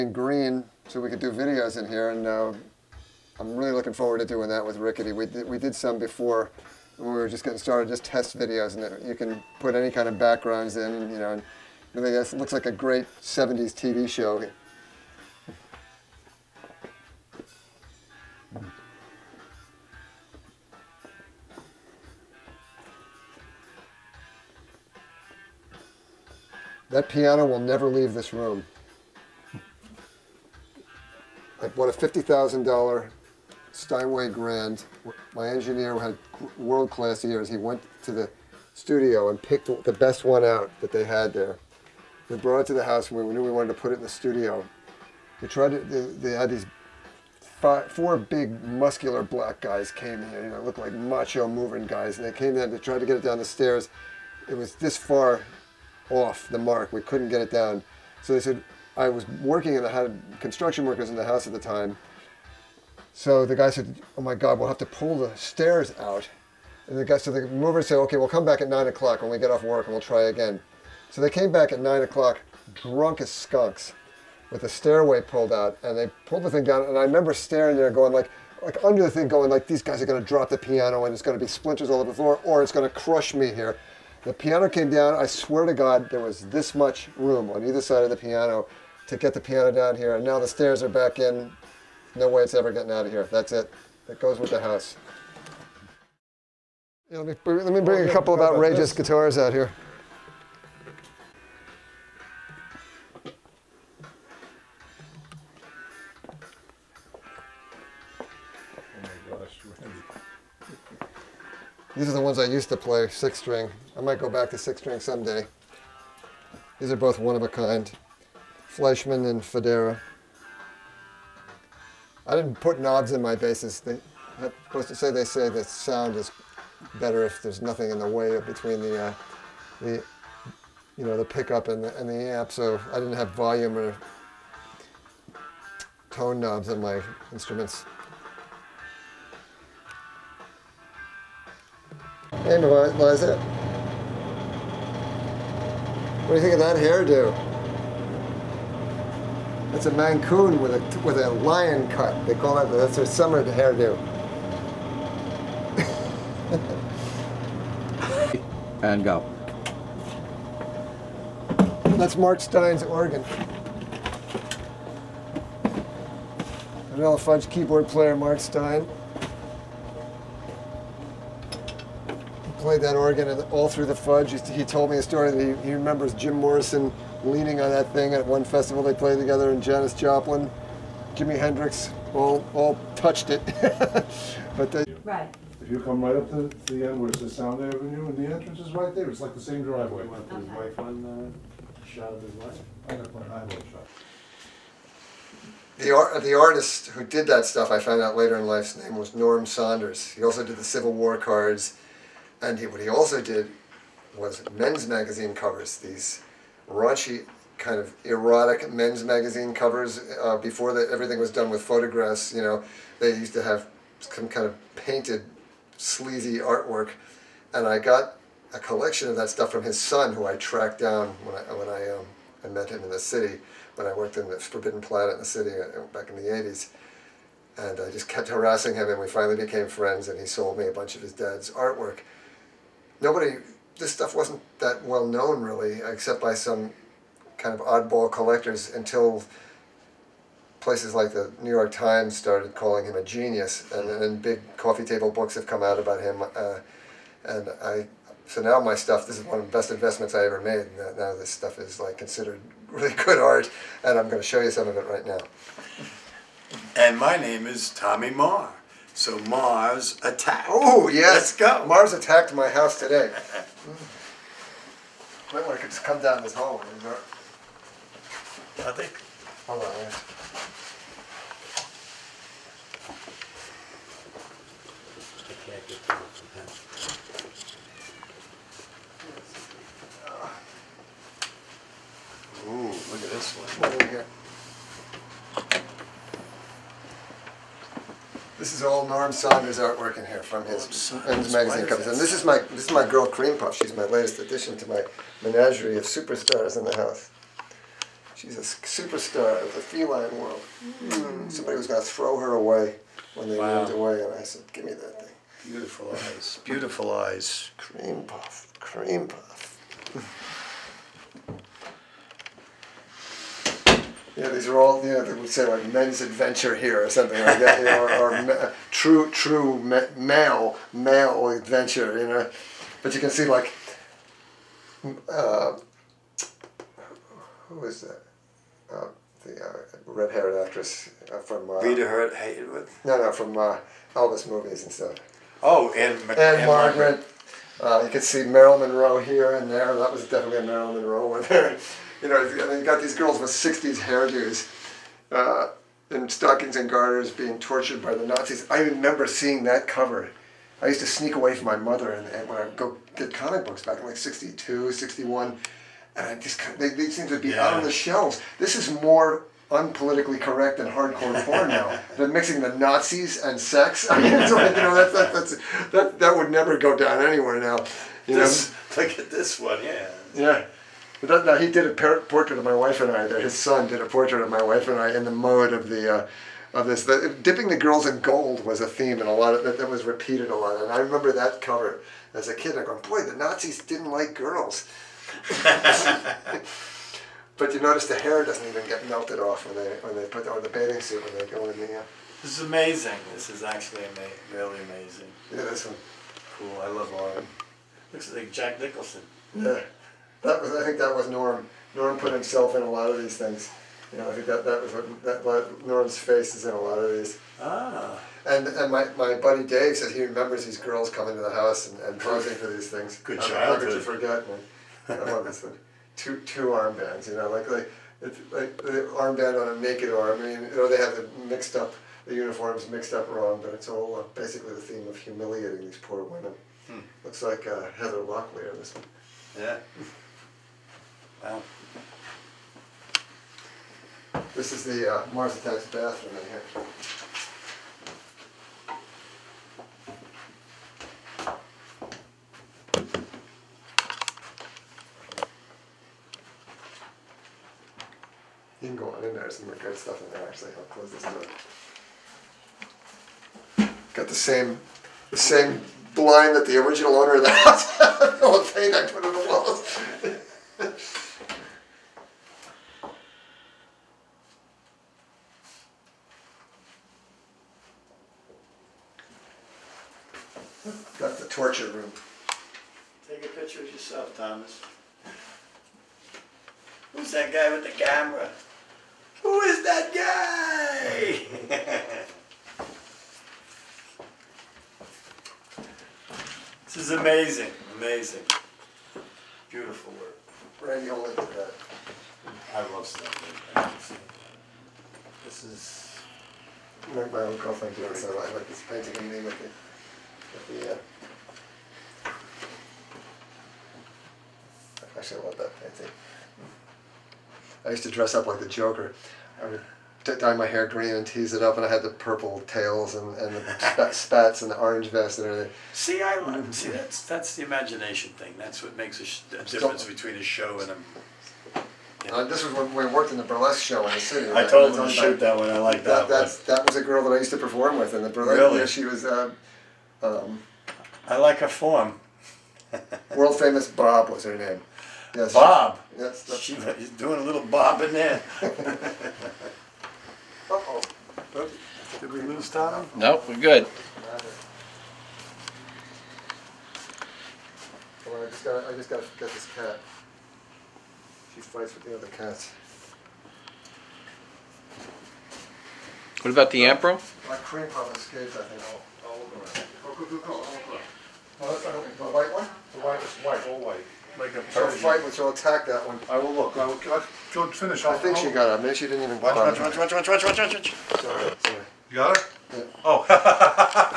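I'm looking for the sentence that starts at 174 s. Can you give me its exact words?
He told me a story that he, he remembers Jim Morrison leaning on that thing.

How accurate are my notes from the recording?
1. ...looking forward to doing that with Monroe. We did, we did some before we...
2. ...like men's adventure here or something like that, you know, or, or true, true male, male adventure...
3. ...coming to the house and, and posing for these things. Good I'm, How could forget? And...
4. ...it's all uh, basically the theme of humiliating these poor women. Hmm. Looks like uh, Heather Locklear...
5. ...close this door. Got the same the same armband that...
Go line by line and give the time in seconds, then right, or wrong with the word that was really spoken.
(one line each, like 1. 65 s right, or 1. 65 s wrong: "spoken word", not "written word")
1. 3 s wrong: "Rickety", not "Monroe"
2. 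315 s right
3. 410 s right
4. 423 s right
5. 450 s wrong: "blind", not "armband".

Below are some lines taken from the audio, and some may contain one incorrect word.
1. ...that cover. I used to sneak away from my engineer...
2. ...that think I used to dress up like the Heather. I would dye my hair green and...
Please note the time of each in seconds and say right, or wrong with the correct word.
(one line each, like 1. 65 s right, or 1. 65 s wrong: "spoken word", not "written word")
1. 349 s wrong: "mother", not "engineer"
2. 505 s wrong: "Joker", not "Heather".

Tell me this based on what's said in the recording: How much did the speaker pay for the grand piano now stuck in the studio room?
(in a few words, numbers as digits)
$50,000.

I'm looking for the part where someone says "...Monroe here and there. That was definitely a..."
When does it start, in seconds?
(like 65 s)
338 s.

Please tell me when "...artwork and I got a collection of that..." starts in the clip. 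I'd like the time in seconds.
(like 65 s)
216 s.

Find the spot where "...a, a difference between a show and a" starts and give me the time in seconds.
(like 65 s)
518 s.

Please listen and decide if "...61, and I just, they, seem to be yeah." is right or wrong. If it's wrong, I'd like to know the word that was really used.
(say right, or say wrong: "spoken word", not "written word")
right.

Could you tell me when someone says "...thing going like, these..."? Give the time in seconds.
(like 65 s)
79 s.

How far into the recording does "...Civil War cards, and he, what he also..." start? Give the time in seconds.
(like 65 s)
200 s.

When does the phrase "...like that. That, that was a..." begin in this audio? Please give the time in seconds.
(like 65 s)
525 s.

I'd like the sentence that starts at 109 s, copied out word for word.
Oh These are the ones I used to play, six string.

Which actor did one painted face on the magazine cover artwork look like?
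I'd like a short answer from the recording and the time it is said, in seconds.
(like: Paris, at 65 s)
Jack Nicholson, at 398 s.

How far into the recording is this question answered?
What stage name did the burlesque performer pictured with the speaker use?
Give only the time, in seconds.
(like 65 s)
533 s.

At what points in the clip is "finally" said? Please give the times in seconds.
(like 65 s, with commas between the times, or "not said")
229 s.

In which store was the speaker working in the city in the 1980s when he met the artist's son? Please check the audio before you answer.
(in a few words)
Forbidden Planet.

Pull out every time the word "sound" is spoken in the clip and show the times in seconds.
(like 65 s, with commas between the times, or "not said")
125 s, 187 s.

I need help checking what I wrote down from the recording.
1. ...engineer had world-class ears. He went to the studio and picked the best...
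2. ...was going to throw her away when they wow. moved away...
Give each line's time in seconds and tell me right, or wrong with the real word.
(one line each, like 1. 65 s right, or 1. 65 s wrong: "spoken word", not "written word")
1. 35 s right
2. 301 s right.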